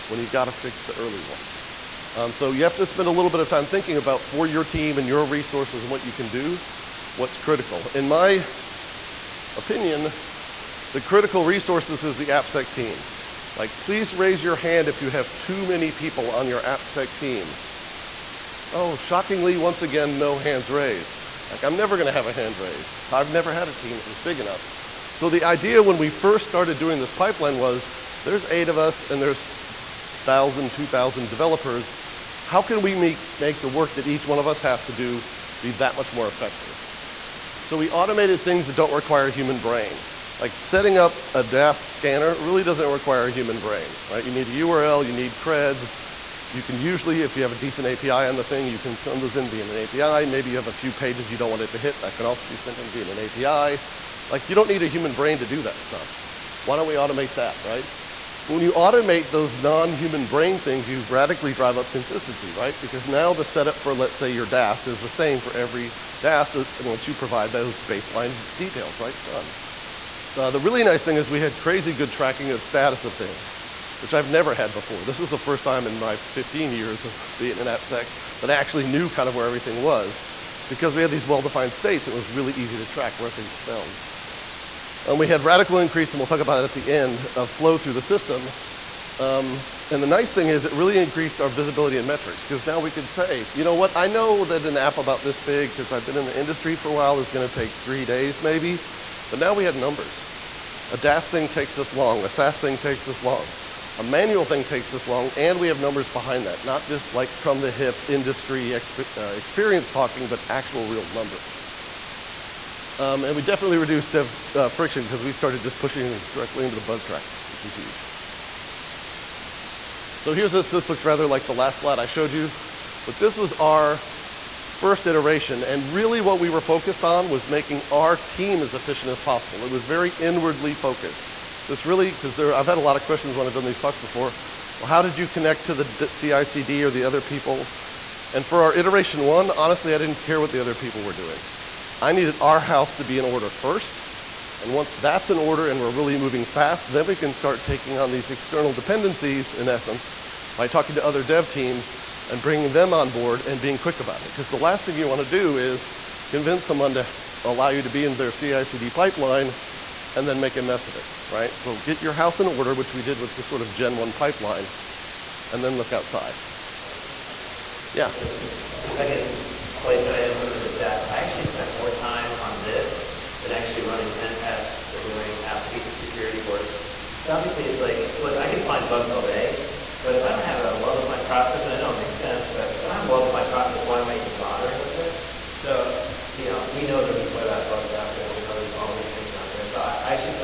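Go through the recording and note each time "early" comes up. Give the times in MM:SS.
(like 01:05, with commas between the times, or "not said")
00:00.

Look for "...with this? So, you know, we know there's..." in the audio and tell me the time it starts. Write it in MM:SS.
03:04.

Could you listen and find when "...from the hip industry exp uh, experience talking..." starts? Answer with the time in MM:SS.
01:47.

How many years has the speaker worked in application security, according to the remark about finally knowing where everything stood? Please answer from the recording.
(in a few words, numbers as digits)
15.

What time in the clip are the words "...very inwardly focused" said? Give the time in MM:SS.
02:09.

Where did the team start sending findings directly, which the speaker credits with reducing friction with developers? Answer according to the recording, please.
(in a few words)
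The bug tracker.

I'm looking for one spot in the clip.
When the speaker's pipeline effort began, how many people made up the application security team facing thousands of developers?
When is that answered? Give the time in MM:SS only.
00:28.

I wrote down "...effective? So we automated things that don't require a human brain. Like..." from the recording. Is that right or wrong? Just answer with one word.
right.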